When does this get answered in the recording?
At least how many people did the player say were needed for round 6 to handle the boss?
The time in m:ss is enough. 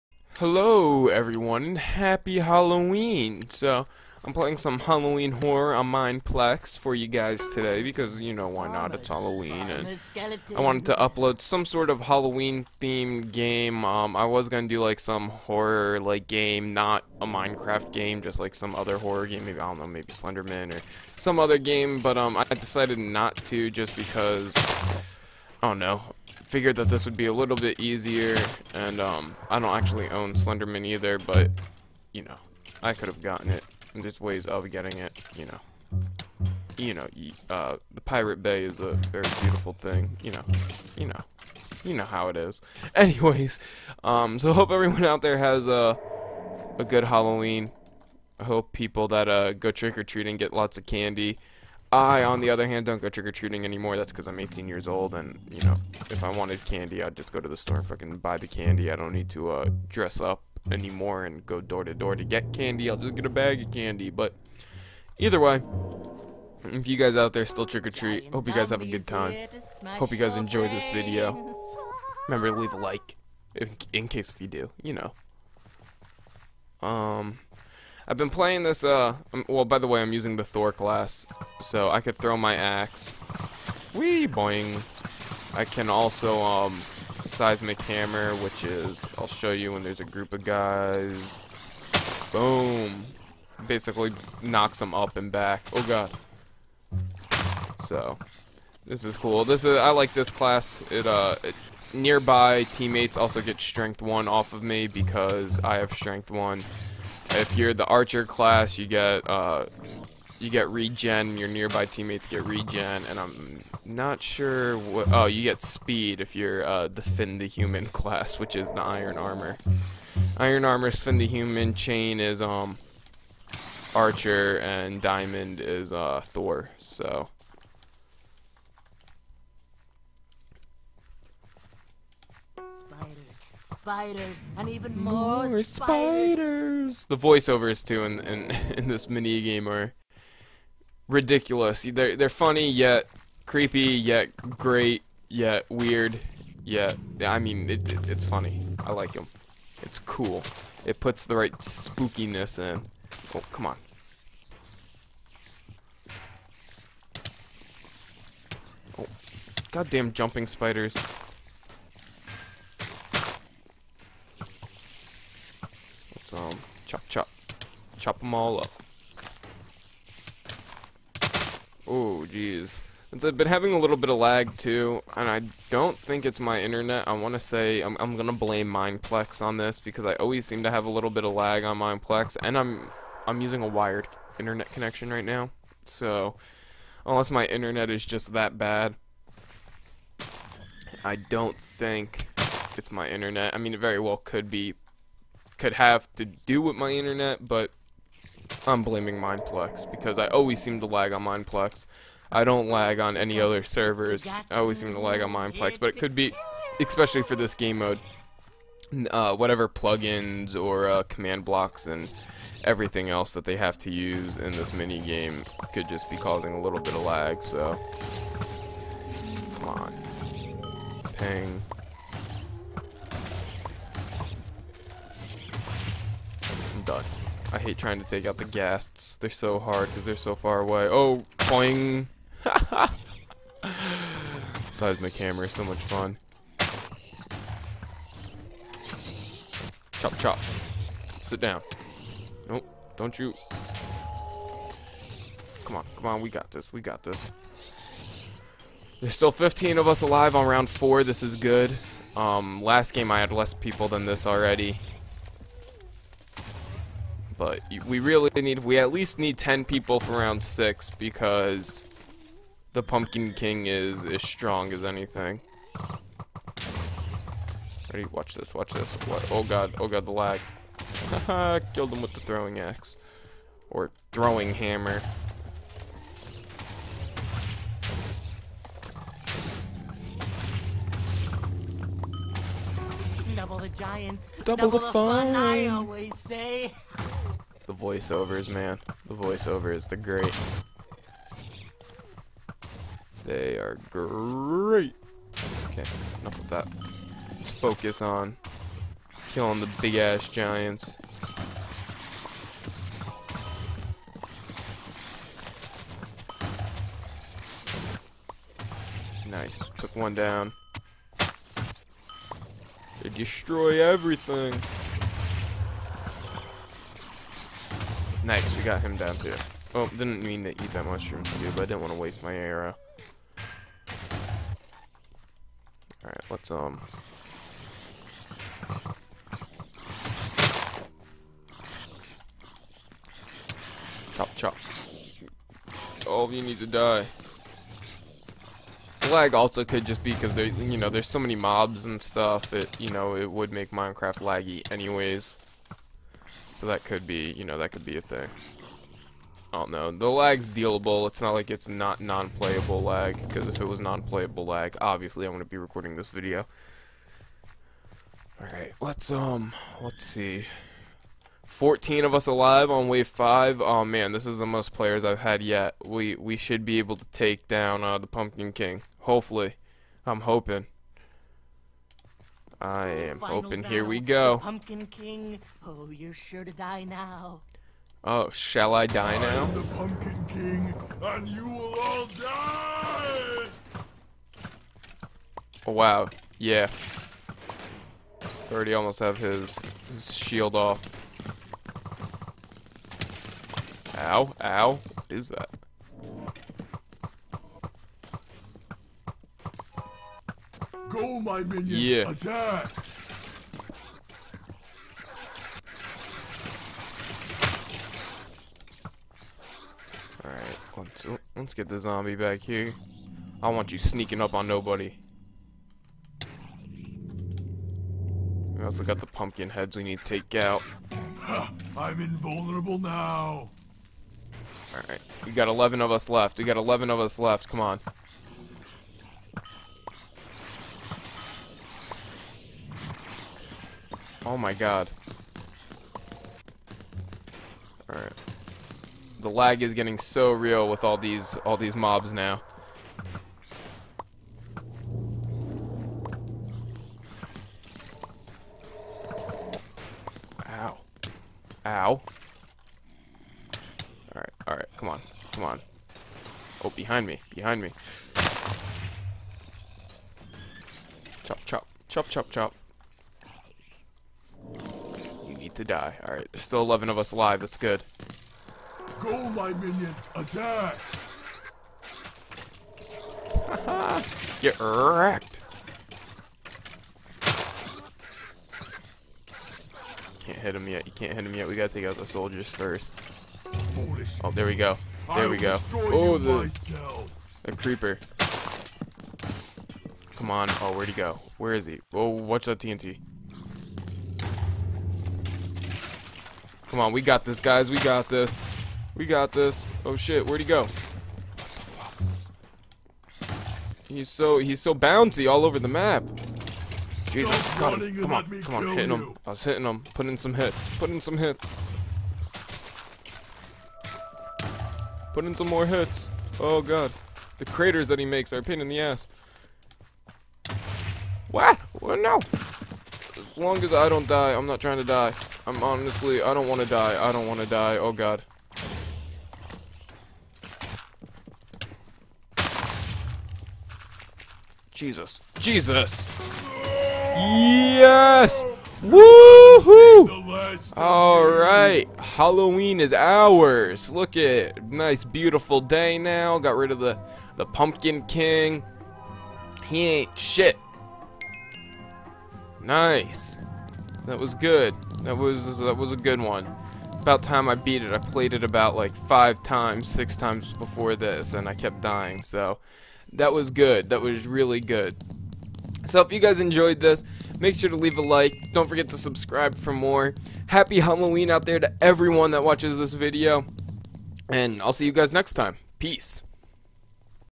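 4:19.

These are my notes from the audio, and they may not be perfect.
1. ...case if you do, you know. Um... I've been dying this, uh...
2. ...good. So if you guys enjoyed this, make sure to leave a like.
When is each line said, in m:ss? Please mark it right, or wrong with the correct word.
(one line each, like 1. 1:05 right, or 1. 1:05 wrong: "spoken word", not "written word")
1. 1:14 wrong: "playing", not "dying"
2. 9:24 right.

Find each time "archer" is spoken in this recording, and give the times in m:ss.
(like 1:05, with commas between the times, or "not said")
1:47, 2:03.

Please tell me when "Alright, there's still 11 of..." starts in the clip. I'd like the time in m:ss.
7:46.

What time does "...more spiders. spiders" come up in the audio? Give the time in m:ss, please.
2:15.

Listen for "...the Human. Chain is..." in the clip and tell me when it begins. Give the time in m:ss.
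2:01.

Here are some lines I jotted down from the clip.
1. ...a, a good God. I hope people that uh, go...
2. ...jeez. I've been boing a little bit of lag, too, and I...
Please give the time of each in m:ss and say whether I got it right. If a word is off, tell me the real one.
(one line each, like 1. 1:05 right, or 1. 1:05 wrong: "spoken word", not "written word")
1. 0:45 wrong: "Halloween", not "God"
2. 2:52 wrong: "having", not "boing".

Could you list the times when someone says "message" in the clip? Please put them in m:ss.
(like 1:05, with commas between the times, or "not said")
not said.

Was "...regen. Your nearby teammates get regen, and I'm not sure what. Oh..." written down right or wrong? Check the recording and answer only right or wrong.
right.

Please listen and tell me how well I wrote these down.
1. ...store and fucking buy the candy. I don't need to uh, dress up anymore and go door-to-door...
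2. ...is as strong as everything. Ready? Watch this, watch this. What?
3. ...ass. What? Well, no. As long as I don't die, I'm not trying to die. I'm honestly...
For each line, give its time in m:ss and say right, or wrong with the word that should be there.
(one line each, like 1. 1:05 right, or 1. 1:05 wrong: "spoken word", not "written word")
1. 0:57 right
2. 4:23 wrong: "anything", not "everything"
3. 8:38 right.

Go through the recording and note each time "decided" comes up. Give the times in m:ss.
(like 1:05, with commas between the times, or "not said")
0:22.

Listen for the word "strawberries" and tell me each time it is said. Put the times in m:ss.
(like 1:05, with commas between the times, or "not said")
not said.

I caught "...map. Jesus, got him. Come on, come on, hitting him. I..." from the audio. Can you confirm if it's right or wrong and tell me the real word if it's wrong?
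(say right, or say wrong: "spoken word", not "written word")
right.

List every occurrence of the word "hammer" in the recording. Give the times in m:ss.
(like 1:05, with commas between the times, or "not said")
1:27, 3:55, 4:34.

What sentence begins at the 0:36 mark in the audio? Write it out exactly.
You know, uh, the Pirate Bay is a very beautiful thing, you know, you know, you know how it is.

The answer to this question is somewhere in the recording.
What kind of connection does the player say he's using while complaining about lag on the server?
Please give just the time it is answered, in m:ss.
3:03.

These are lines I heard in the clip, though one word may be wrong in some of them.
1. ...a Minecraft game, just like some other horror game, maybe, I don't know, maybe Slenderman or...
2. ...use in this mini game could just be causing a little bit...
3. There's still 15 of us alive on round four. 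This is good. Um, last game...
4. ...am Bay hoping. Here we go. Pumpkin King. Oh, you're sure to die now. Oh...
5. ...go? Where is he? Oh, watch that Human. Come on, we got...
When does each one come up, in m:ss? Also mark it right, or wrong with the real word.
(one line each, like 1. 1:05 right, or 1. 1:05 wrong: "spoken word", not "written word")
1. 0:17 right
2. 3:33 right
3. 4:09 right
4. 6:12 wrong: "Final", not "Bay"
5. 8:10 wrong: "TNT", not "Human".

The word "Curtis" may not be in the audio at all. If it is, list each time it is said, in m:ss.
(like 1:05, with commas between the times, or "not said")
not said.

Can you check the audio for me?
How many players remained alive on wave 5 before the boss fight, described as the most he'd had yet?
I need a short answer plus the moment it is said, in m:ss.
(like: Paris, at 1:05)
14, at 6:01.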